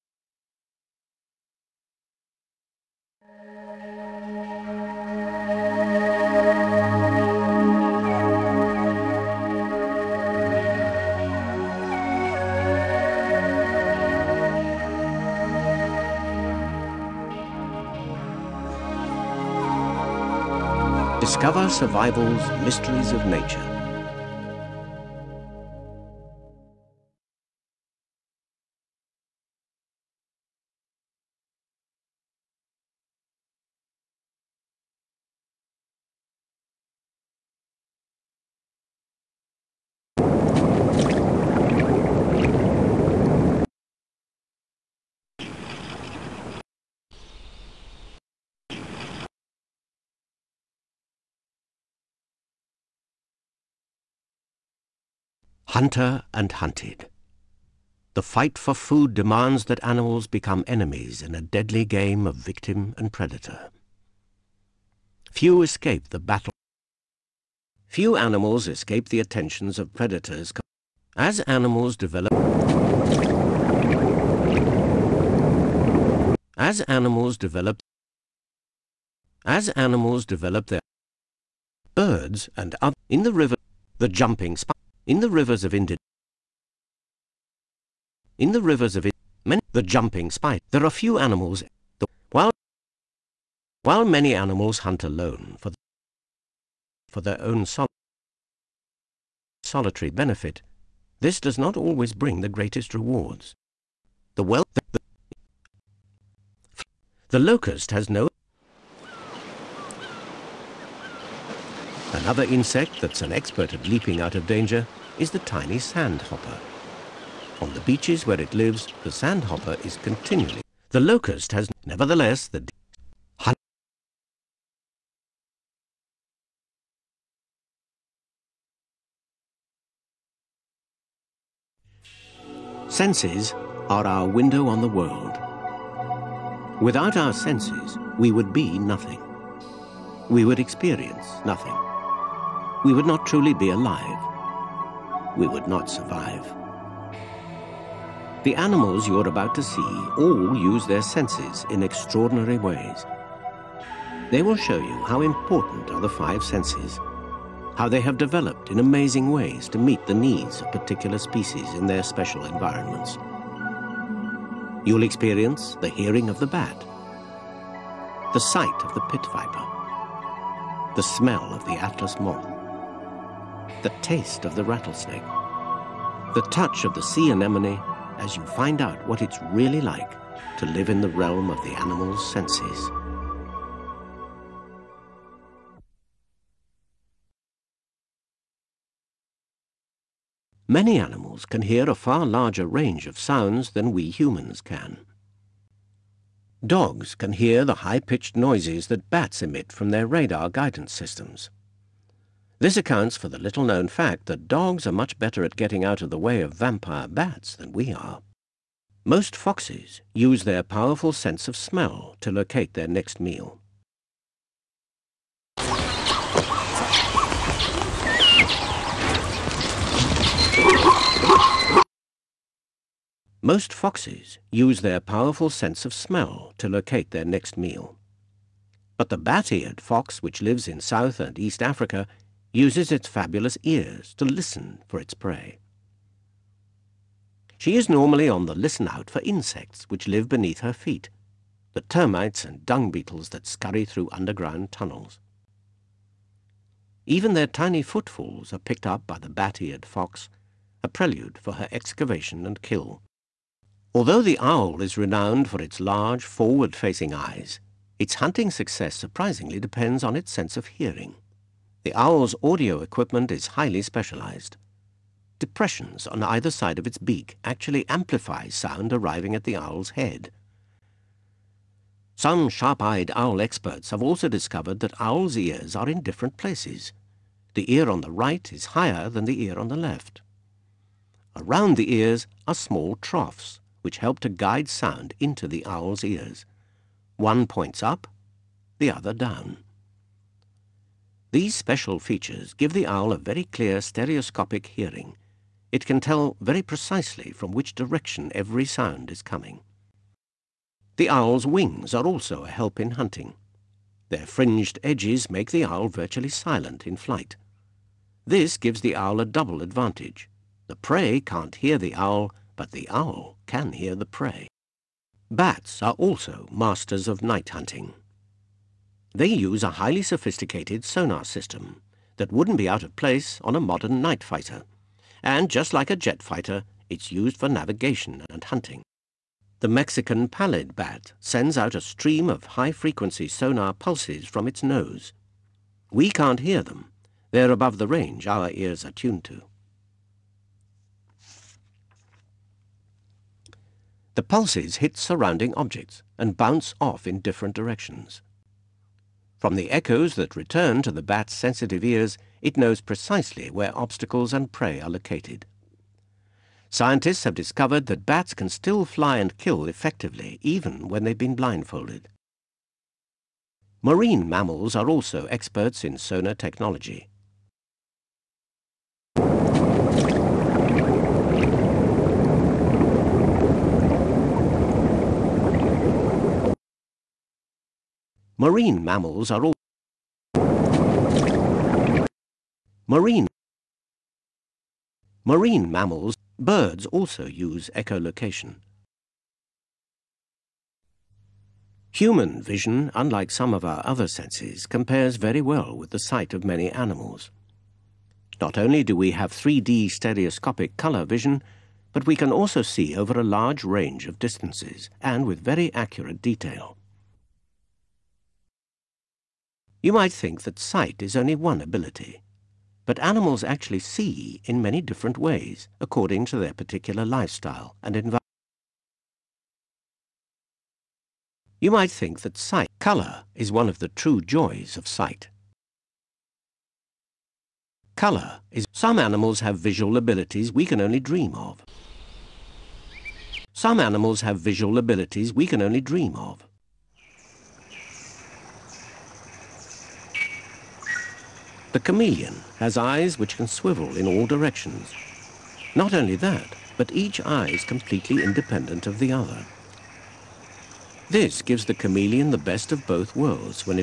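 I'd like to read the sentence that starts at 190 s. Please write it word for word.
Many animals can hear a far larger range of sounds than we humans can.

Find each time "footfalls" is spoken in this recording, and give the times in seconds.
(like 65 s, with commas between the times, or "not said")
247 s.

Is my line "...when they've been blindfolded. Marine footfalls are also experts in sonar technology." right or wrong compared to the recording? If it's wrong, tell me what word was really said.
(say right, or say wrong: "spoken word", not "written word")
wrong: "mammals", not "footfalls".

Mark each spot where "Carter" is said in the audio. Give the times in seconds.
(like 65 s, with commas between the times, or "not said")
not said.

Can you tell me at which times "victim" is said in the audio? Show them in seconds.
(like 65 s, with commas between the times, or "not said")
62 s.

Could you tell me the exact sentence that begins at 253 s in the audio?
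Although the owl is renowned for its large, forward-facing eyes, its hunting success surprisingly depends on its sense of hearing.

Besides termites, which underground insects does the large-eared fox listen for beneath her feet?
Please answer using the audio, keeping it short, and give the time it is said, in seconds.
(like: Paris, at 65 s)
dung beetles, at 242 s.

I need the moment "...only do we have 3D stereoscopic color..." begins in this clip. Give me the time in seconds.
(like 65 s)
398 s.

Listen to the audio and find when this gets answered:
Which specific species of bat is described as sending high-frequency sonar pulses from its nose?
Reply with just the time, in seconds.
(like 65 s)
329 s.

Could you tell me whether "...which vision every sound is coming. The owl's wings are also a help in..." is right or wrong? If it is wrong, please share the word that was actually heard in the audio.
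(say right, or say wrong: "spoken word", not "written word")
wrong: "direction", not "vision".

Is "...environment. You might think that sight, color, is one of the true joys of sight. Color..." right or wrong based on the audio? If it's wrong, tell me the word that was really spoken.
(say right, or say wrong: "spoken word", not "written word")
right.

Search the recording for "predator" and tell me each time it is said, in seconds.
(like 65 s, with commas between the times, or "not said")
63 s, 69 s.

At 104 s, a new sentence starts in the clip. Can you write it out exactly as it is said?
The wealth the, the, the locust has no Another insect that's an expert at leaping out of danger is the tiny sandhopper.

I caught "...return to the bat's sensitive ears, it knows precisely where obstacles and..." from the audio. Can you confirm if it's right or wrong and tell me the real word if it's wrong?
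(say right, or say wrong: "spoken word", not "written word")
right.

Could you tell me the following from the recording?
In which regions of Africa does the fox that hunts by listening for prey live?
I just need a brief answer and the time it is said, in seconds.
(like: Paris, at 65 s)
South and East Africa, at 230 s.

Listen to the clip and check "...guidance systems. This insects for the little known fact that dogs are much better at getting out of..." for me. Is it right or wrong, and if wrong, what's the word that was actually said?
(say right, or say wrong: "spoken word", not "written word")
wrong: "accounts", not "insects".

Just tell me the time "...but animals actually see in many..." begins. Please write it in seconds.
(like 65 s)
412 s.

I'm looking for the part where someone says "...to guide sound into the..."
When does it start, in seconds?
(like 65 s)
284 s.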